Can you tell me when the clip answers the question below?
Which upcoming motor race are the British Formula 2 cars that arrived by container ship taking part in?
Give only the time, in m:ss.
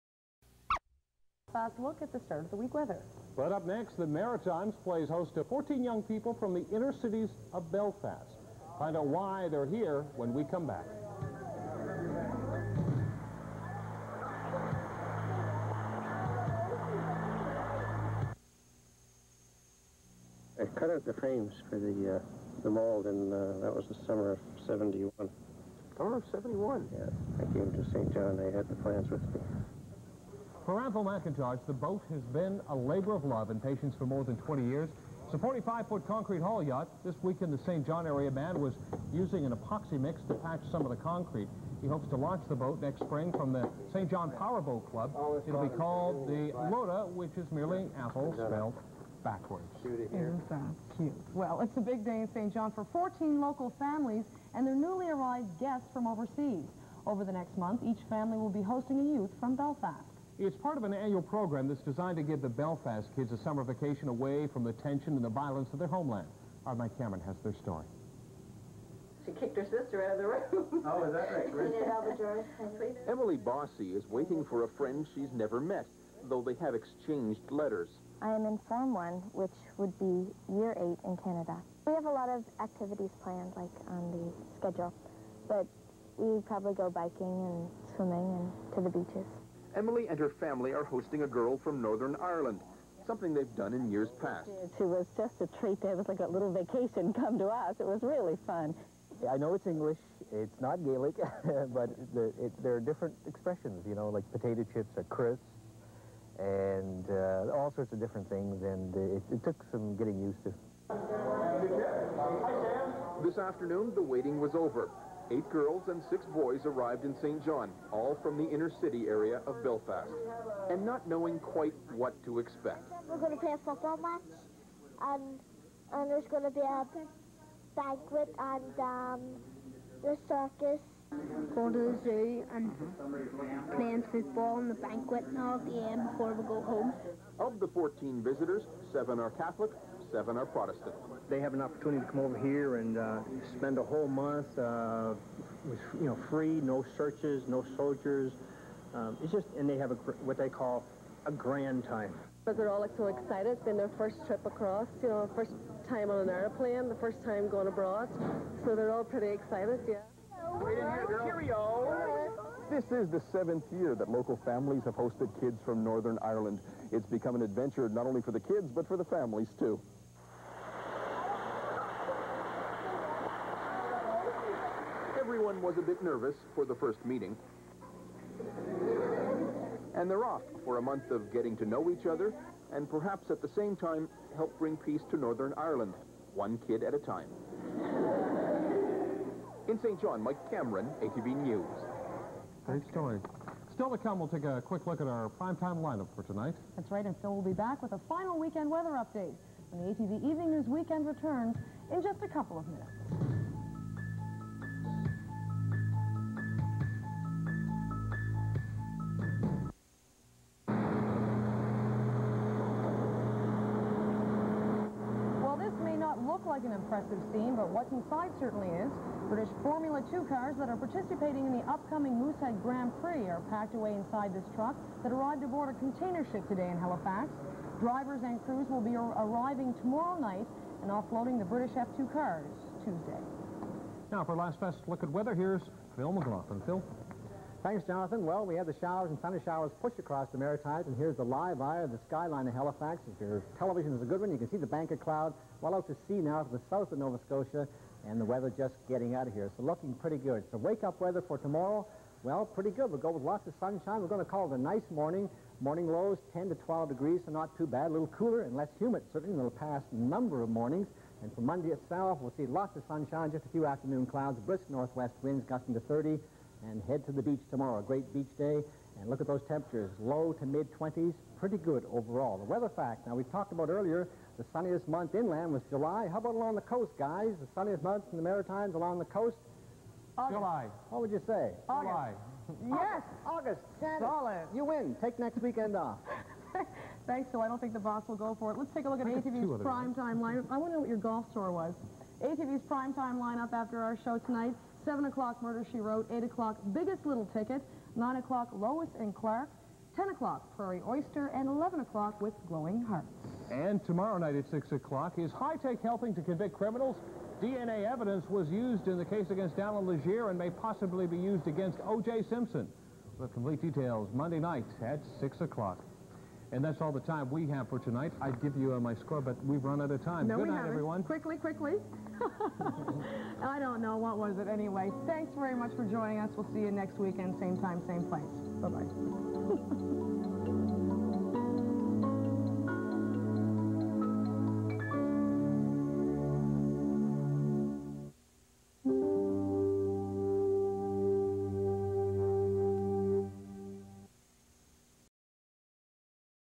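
3:42.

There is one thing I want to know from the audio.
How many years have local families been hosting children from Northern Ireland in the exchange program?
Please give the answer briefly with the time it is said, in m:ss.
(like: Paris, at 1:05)
7, at 2:43.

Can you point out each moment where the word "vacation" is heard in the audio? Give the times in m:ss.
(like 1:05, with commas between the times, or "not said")
1:03, 1:36.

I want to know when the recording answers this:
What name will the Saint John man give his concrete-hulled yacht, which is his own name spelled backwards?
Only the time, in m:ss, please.
0:46.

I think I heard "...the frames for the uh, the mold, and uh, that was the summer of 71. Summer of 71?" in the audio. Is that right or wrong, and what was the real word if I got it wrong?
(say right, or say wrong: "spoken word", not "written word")
right.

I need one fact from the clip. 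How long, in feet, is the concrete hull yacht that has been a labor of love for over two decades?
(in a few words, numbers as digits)
45.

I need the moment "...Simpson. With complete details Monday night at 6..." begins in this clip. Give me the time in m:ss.
5:12.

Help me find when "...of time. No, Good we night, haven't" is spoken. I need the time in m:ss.
5:19.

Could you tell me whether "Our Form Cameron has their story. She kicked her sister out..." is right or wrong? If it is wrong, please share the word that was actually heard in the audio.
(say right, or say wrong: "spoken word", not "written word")
wrong: "Mike", not "Form".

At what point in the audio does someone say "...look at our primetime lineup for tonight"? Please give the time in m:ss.
3:14.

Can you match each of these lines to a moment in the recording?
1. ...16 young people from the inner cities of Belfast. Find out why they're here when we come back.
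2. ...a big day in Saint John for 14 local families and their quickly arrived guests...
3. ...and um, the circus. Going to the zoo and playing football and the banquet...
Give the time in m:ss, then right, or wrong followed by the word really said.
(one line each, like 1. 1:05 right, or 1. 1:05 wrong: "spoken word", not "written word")
1. 0:05 wrong: "14", not "16"
2. 0:51 wrong: "newly", not "quickly"
3. 2:08 right.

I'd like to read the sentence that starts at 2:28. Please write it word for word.
Um, it's just, and they have a, what they call a grand time.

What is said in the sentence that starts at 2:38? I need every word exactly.
So they're all pretty excited, yeah.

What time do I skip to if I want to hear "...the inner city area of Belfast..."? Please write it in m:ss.
1:58.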